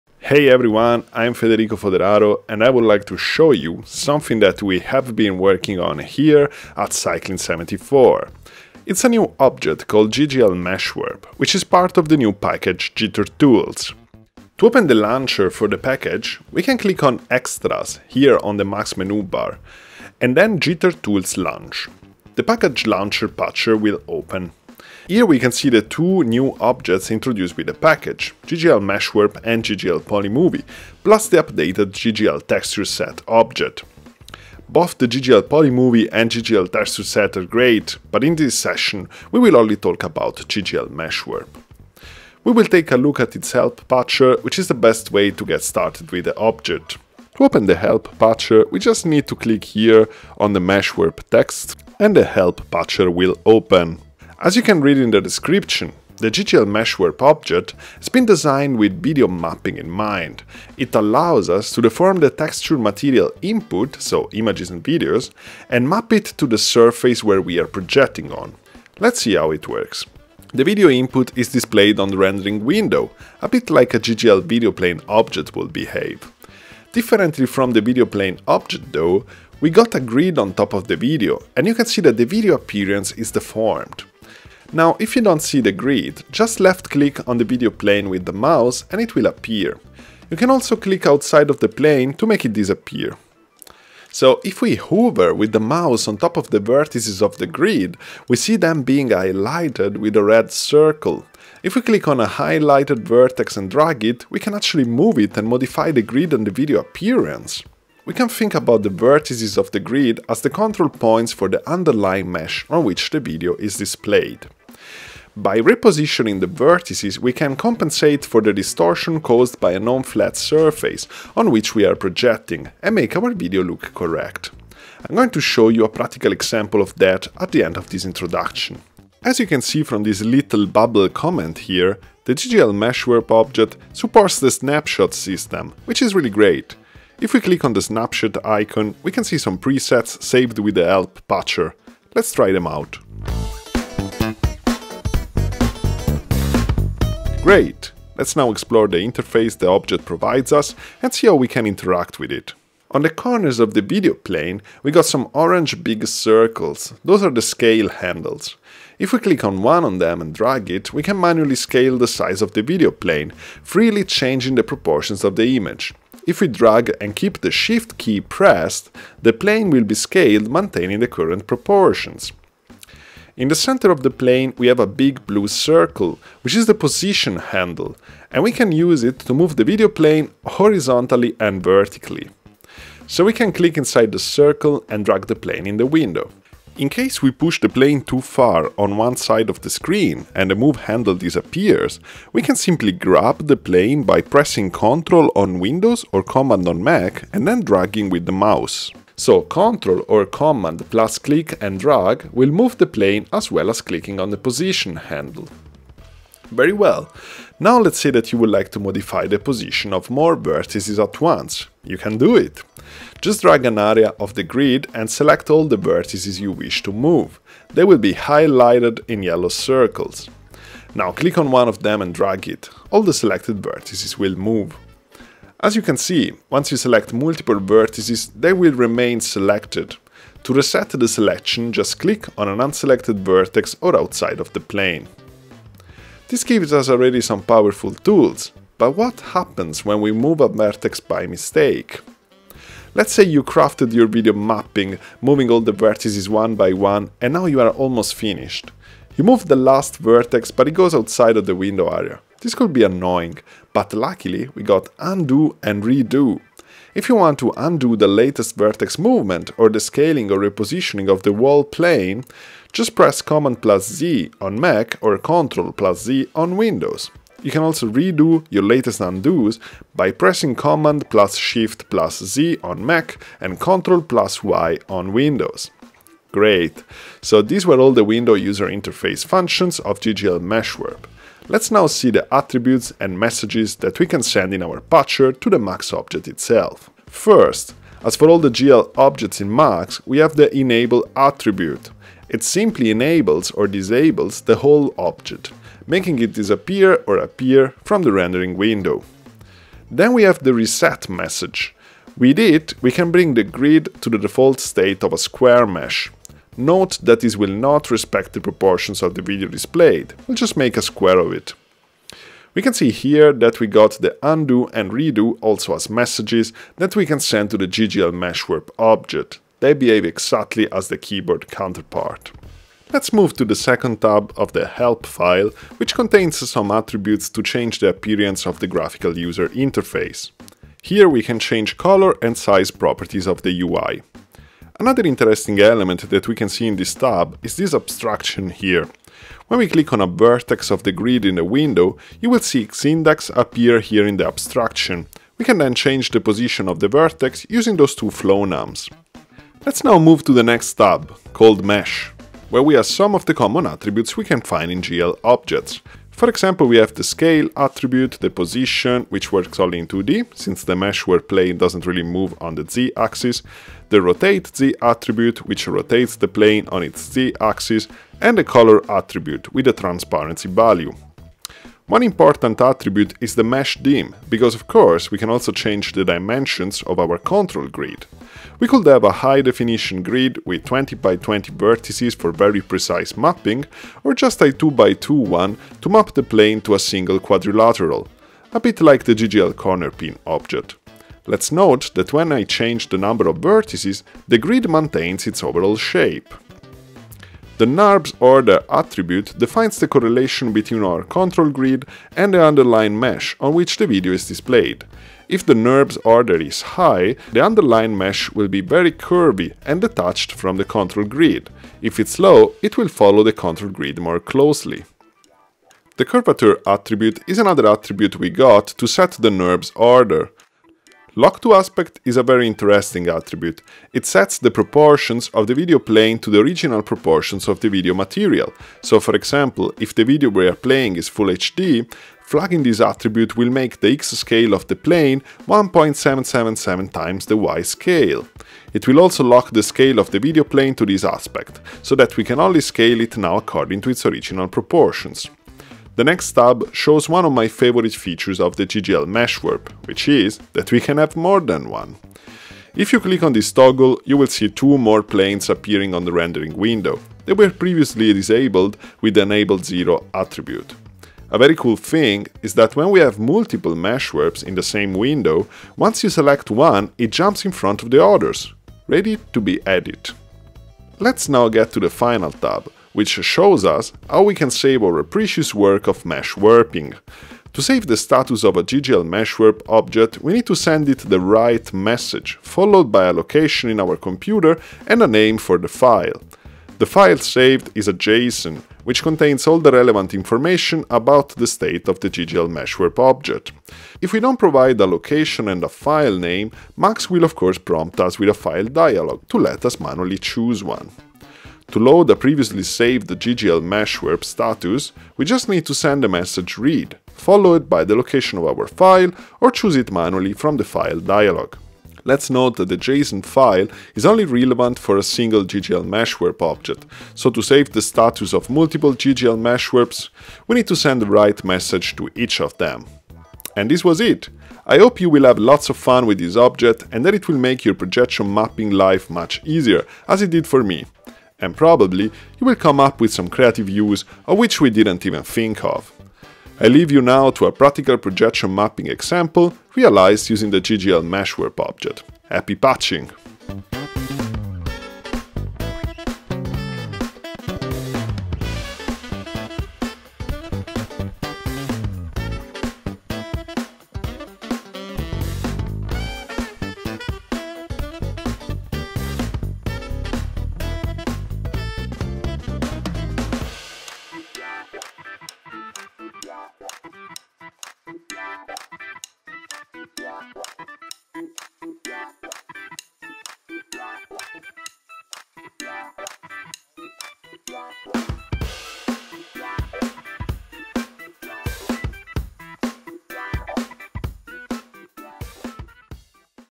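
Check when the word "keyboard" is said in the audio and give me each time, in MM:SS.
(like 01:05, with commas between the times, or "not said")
05:20.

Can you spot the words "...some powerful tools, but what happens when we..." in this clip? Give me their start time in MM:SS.
03:57.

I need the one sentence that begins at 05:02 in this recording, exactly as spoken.
With it, we can bring the grid to the default state of a square mesh.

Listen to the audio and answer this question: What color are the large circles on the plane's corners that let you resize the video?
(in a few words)
Orange.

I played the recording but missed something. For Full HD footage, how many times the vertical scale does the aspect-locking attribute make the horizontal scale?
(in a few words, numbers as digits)
1.777.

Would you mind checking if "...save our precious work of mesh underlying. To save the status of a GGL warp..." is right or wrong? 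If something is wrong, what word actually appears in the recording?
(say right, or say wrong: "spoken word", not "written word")
wrong: "warping", not "underlying".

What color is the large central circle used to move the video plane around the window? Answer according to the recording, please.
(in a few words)
Blue.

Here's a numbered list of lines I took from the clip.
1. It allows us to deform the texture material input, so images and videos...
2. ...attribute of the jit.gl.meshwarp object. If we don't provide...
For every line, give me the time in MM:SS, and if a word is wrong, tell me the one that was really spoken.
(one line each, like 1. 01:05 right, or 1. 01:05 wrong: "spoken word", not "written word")
1. 01:00 right
2. 08:11 wrong: "state", not "attribute".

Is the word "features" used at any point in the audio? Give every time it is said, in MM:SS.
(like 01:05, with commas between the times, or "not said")
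07:27.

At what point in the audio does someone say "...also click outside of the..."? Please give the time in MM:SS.
01:30.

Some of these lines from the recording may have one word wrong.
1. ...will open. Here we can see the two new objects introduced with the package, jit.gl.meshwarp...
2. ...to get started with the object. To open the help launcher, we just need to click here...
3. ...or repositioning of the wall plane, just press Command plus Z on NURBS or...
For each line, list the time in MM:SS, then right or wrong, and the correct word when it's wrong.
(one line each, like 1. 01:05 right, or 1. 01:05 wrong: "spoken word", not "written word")
1. 00:23 right
2. 00:45 wrong: "patcher", not "launcher"
3. 04:20 wrong: "Mac", not "NURBS".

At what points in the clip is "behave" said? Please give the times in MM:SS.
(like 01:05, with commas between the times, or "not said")
01:15, 05:19.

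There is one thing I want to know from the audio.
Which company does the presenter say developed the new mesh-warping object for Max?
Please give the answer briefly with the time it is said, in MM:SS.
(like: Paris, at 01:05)
Cycling 74, at 00:06.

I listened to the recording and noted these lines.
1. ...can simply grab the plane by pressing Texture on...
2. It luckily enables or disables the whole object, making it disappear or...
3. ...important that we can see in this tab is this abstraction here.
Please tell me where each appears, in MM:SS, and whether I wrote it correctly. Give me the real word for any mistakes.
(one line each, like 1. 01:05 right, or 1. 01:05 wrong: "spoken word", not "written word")
1. 03:12 wrong: "Ctrl", not "Texture"
2. 04:52 wrong: "simply", not "luckily"
3. 05:35 wrong: "element", not "important".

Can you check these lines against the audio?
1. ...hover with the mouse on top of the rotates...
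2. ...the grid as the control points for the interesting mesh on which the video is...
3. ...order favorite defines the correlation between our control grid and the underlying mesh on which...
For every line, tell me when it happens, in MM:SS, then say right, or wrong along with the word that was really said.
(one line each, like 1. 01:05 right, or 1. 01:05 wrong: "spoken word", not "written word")
1. 01:34 wrong: "vertices", not "rotates"
2. 01:49 wrong: "underlying", not "interesting"
3. 06:38 wrong: "attribute", not "favorite".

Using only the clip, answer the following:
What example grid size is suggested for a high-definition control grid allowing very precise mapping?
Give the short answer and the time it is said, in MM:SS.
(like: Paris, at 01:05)
20 by 20, at 06:20.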